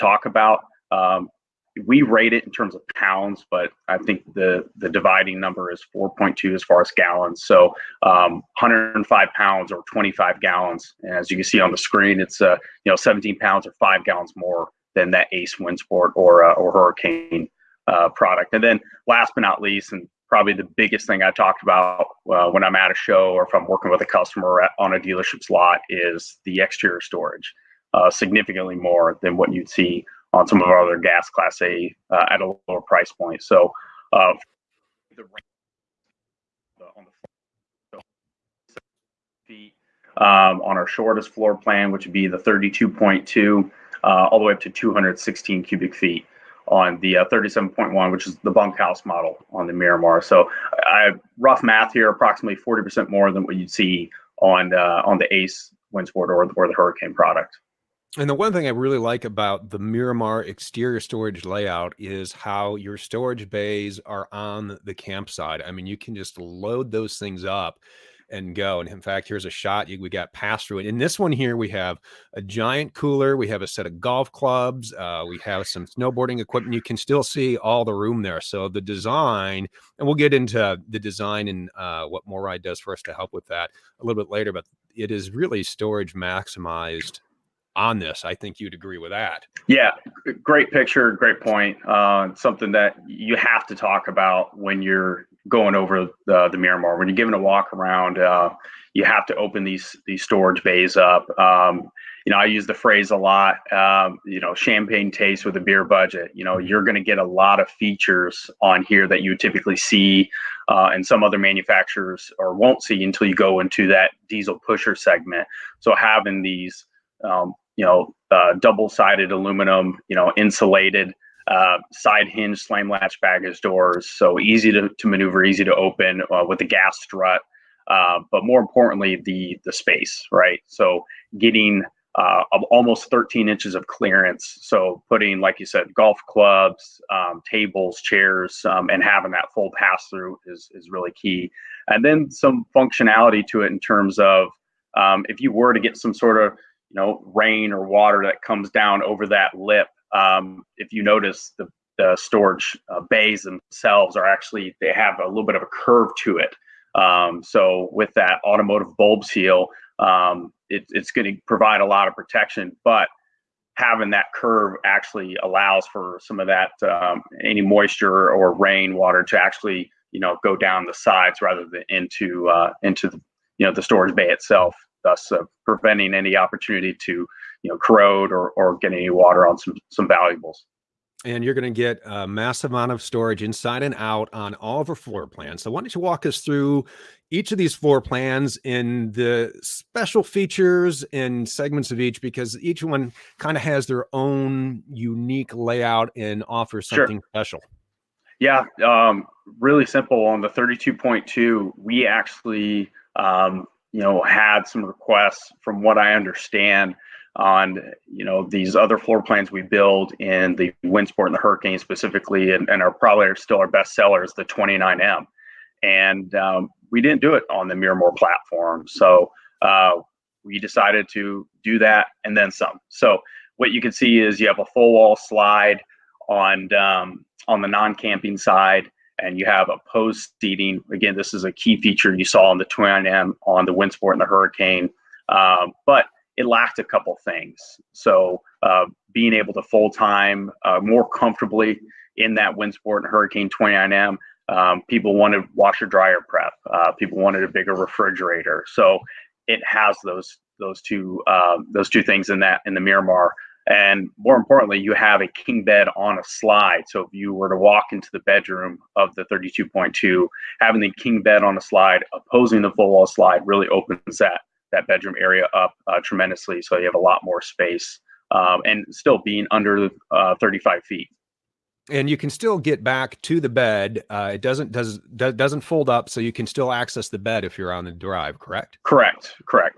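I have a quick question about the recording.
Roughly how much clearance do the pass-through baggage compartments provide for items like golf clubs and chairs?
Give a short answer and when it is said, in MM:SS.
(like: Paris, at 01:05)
almost 13 inches, at 02:12.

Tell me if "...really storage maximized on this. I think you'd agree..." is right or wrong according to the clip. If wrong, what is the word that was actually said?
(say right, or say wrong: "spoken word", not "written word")
right.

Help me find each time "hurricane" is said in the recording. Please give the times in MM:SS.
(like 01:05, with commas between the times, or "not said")
00:16, 00:56, 03:31, 03:54, 04:03.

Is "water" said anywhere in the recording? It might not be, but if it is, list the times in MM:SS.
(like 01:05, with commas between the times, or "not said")
02:27, 02:48, 02:59.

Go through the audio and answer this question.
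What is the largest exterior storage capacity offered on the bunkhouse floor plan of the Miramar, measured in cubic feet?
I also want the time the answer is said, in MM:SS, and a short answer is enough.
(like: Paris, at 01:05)
216 cubic feet, at 00:44.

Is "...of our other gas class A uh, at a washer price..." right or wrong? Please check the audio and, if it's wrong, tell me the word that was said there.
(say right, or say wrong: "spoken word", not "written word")
wrong: "lower", not "washer".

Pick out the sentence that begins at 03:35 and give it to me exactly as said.
And um, we didn't do it on the Miramar platform.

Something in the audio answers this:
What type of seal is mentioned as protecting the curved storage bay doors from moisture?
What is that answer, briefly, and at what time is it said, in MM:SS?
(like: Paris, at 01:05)
automotive bulb seal, at 02:38.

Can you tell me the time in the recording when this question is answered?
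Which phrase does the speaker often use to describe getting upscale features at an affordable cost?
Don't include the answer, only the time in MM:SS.
01:44.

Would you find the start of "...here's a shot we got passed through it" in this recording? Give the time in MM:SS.
01:09.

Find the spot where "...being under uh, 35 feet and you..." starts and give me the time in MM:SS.
04:29.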